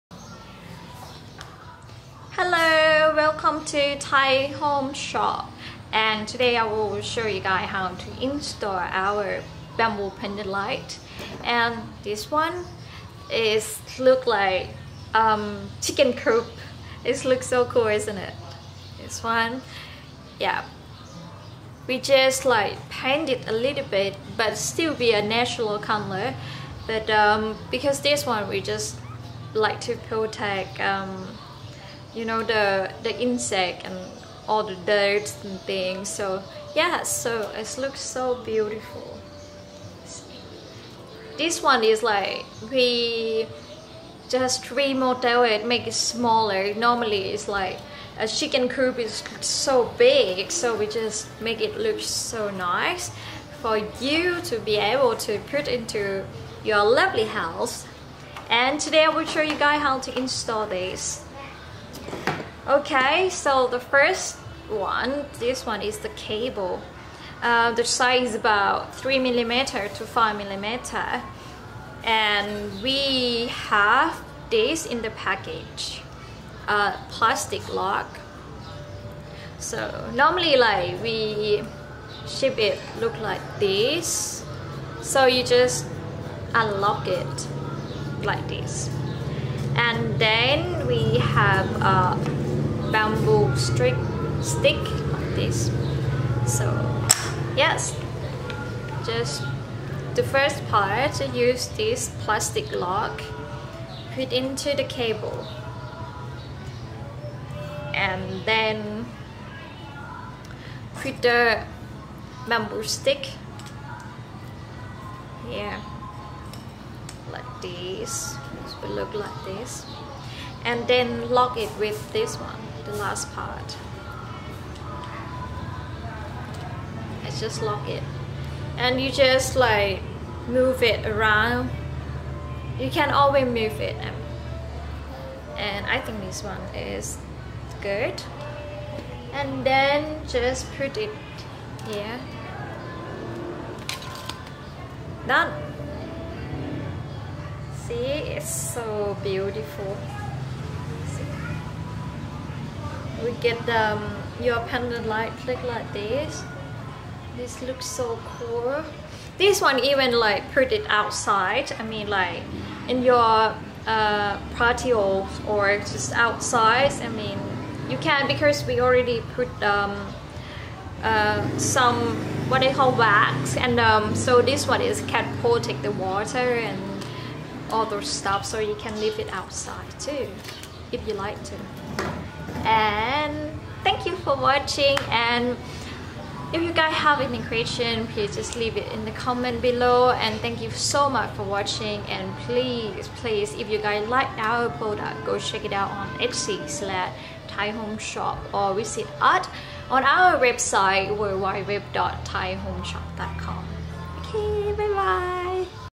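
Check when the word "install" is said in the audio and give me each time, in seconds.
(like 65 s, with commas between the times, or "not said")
8 s, 60 s.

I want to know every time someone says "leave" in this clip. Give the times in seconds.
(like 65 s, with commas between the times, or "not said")
178 s, 188 s.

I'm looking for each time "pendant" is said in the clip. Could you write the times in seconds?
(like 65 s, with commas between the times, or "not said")
10 s, 154 s.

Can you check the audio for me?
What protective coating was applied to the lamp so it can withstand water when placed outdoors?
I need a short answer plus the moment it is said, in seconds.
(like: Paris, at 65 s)
Wax, at 172 s.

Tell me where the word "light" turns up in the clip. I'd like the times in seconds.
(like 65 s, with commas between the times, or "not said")
10 s, 155 s.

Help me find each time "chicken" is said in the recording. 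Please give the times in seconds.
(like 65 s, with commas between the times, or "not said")
15 s, 48 s.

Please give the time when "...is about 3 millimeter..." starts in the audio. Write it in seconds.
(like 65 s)
68 s.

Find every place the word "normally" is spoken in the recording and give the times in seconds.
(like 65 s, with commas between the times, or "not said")
46 s, 80 s.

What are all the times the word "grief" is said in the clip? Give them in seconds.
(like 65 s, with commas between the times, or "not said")
not said.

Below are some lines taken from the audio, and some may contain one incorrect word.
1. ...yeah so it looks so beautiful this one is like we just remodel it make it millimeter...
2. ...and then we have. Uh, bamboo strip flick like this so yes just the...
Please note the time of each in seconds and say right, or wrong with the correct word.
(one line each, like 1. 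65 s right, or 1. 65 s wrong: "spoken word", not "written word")
1. 36 s wrong: "smaller", not "millimeter"
2. 89 s wrong: "stick", not "flick".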